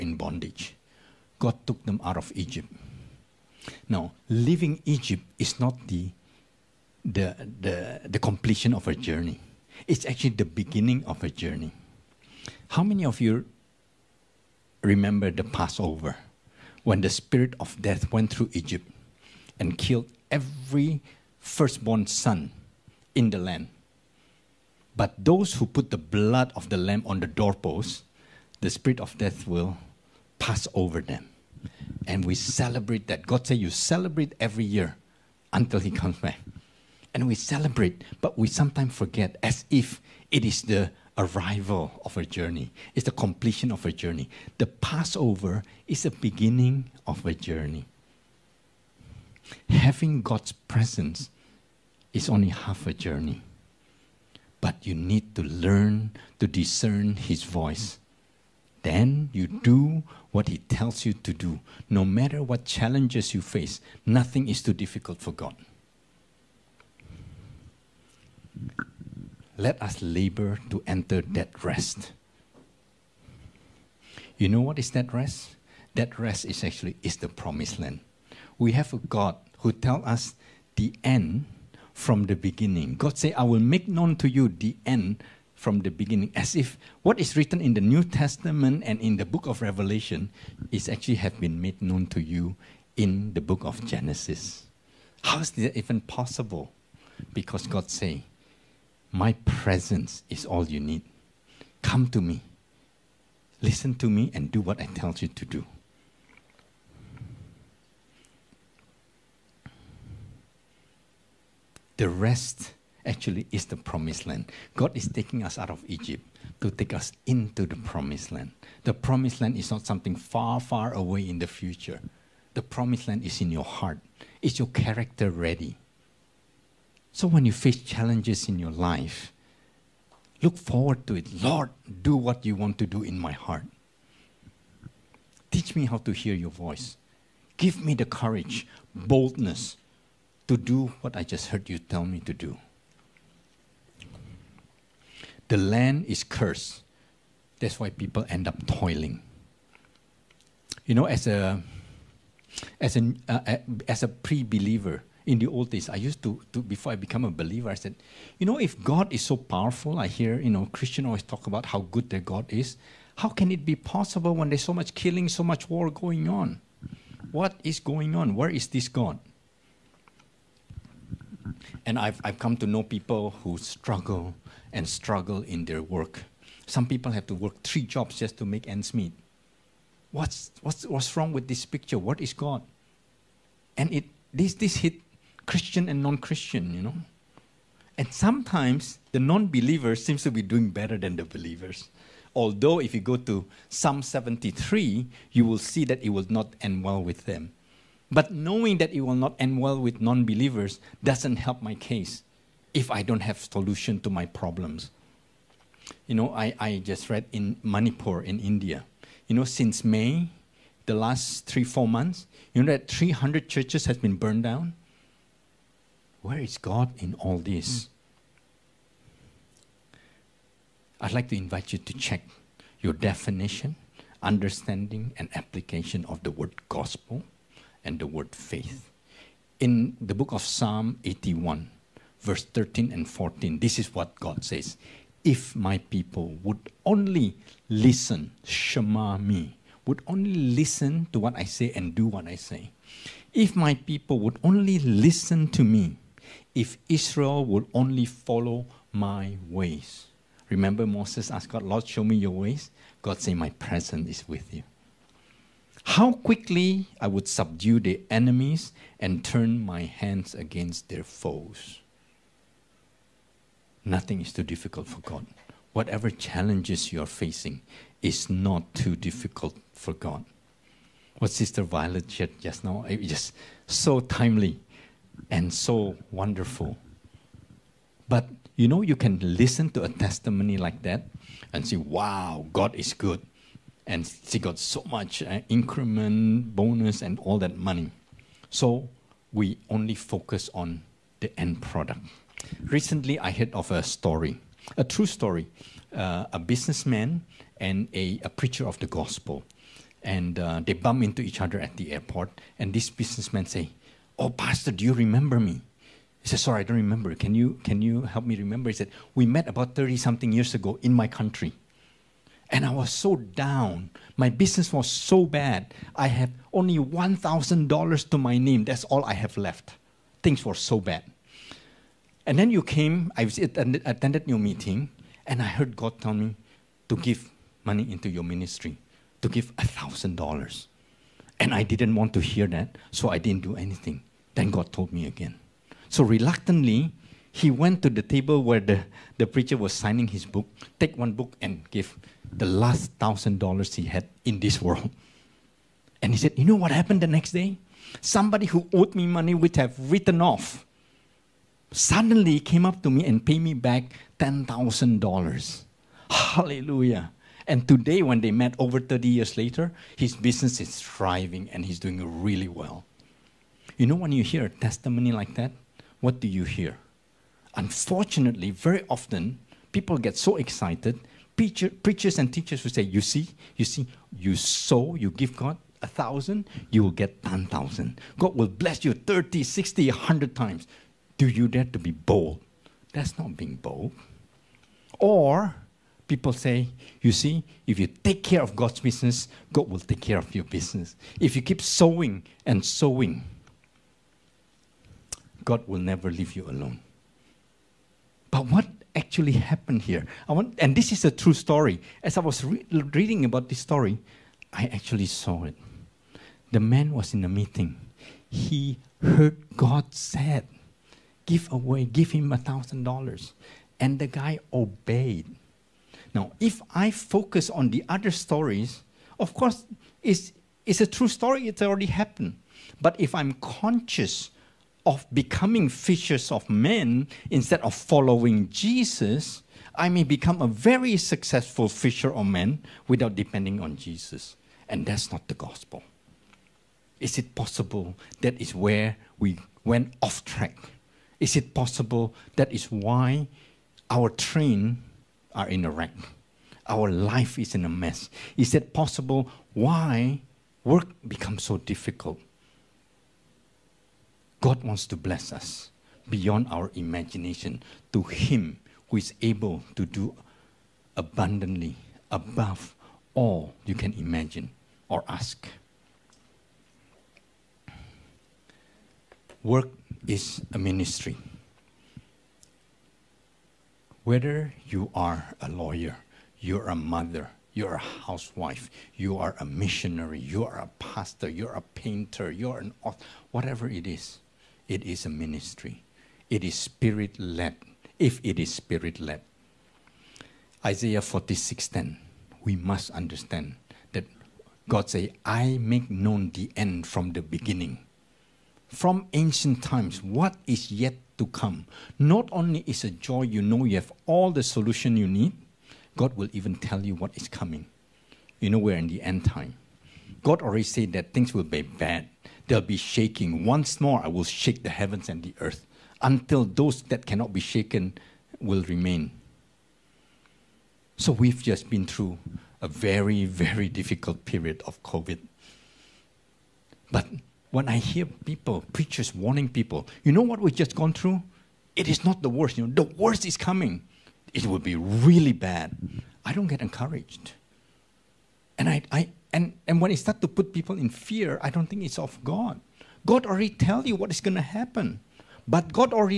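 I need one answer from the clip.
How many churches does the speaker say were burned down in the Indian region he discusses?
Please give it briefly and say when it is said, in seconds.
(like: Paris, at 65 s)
300, at 212 s.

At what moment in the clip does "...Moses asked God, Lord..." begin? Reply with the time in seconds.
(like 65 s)
250 s.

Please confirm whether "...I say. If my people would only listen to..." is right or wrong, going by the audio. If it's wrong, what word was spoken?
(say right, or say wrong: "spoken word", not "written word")
right.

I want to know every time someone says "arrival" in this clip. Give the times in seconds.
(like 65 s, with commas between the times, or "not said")
41 s.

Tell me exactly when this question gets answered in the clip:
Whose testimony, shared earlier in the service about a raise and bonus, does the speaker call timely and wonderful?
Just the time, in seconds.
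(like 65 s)
271 s.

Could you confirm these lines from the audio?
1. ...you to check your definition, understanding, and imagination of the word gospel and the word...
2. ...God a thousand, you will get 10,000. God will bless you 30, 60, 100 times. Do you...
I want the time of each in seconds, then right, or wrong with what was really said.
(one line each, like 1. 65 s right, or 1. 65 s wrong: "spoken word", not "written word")
1. 221 s wrong: "application", not "imagination"
2. 375 s right.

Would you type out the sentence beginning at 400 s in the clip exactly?
I want, and this is a true story.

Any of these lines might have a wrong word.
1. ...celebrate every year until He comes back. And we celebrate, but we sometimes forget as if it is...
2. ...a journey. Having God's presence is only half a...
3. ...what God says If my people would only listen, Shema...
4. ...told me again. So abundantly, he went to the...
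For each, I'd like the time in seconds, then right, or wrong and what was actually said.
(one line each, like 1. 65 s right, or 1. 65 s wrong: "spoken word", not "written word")
1. 33 s right
2. 47 s right
3. 233 s right
4. 334 s wrong: "reluctantly", not "abundantly".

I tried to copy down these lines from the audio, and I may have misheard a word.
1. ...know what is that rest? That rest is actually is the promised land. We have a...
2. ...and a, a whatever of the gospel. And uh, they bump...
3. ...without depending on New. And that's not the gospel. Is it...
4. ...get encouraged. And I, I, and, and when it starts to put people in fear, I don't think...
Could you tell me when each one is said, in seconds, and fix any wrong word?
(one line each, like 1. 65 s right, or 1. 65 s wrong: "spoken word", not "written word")
1. 74 s right
2. 297 s wrong: "preacher", not "whatever"
3. 432 s wrong: "Jesus", not "New"
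4. 536 s right.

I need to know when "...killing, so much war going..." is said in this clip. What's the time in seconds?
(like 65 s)
164 s.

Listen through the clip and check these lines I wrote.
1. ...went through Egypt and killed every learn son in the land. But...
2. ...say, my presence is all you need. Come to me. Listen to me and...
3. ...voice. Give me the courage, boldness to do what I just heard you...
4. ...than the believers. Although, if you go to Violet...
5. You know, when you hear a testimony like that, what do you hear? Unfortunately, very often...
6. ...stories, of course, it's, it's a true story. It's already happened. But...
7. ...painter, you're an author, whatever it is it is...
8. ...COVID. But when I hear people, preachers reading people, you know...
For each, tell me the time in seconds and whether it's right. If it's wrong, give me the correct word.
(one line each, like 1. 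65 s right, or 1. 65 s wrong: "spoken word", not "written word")
1. 18 s wrong: "firstborn", not "learn"
2. 97 s right
3. 136 s right
4. 190 s wrong: "Psalm", not "Violet"
5. 363 s right
6. 418 s right
7. 481 s right
8. 524 s wrong: "warning", not "reading".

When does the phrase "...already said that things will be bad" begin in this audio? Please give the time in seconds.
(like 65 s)
510 s.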